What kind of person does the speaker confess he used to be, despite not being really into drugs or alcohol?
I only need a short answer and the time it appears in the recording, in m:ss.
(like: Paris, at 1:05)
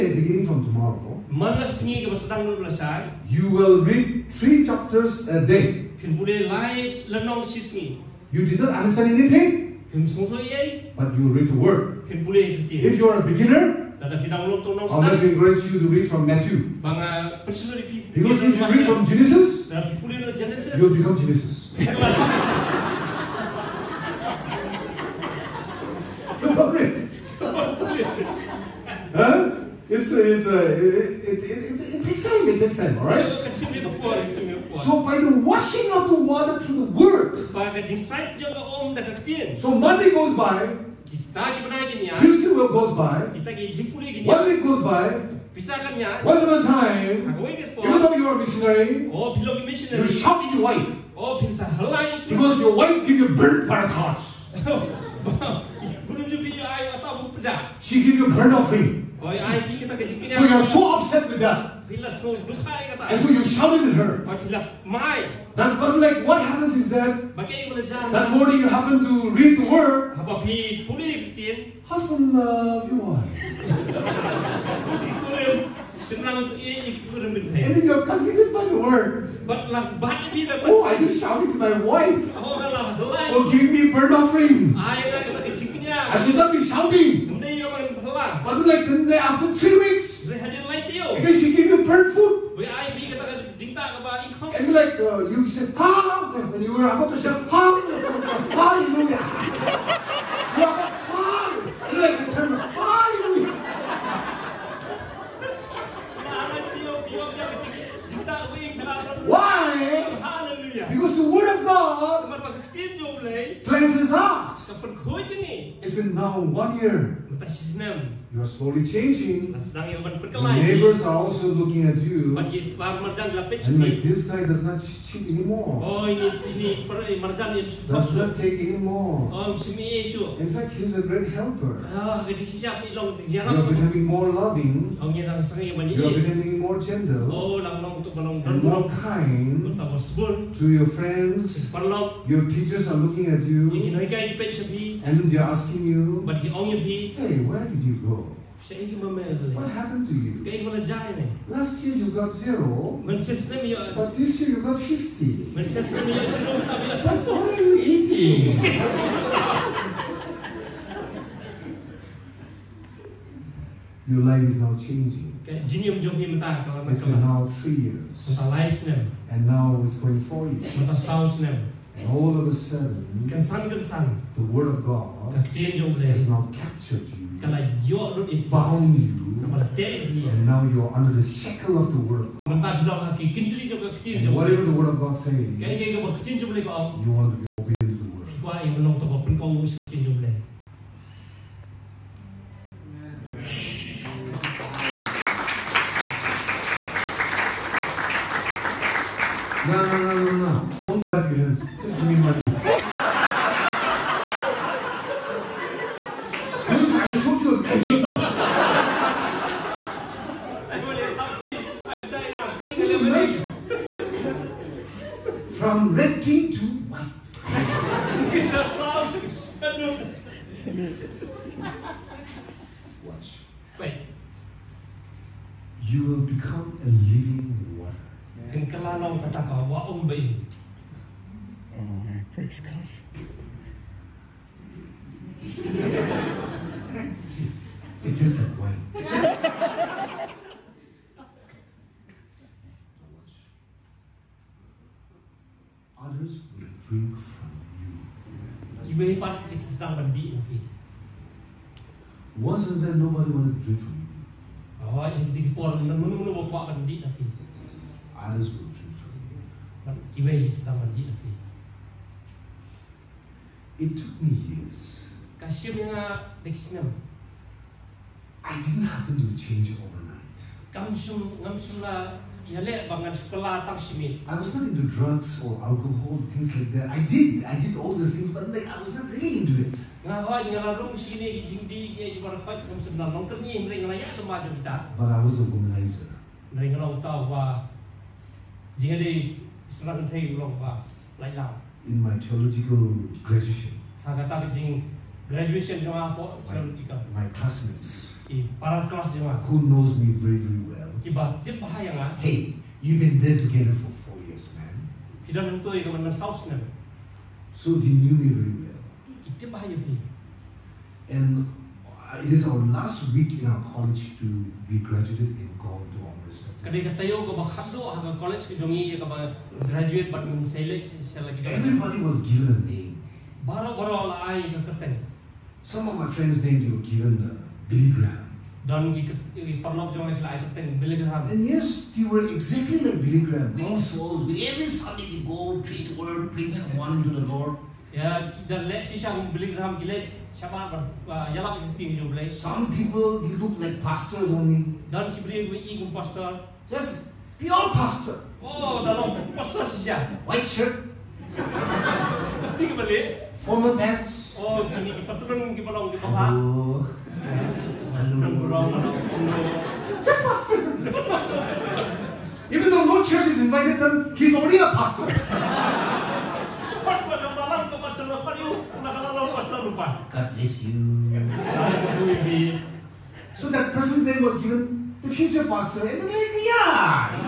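a womanizer, at 4:45.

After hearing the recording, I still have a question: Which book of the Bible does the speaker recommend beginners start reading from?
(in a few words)
Matthew.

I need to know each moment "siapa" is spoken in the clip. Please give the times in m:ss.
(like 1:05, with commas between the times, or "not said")
5:40.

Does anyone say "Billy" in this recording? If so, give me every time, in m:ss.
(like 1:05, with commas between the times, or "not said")
5:27, 5:33, 5:39.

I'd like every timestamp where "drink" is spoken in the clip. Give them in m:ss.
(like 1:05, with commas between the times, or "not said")
4:06, 4:13, 4:18.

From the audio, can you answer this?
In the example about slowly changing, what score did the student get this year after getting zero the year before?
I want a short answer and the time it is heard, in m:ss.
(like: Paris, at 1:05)
50, at 2:34.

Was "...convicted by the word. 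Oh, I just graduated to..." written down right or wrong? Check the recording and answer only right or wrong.
wrong.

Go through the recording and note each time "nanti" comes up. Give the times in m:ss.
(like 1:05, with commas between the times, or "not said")
4:17, 4:21.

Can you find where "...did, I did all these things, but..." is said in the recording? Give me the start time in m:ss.
4:37.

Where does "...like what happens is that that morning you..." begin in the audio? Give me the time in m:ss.
1:05.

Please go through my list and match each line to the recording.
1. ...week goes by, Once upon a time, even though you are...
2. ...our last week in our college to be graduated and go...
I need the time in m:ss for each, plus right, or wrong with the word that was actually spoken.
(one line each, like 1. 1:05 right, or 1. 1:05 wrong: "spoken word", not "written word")
1. 0:44 right
2. 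5:12 right.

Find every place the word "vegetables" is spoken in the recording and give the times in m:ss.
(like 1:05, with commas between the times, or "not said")
not said.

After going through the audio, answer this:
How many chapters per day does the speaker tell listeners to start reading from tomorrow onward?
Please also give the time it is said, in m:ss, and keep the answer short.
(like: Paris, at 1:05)
3, at 0:04.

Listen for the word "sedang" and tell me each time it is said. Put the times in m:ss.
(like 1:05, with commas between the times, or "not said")
4:09, 4:20.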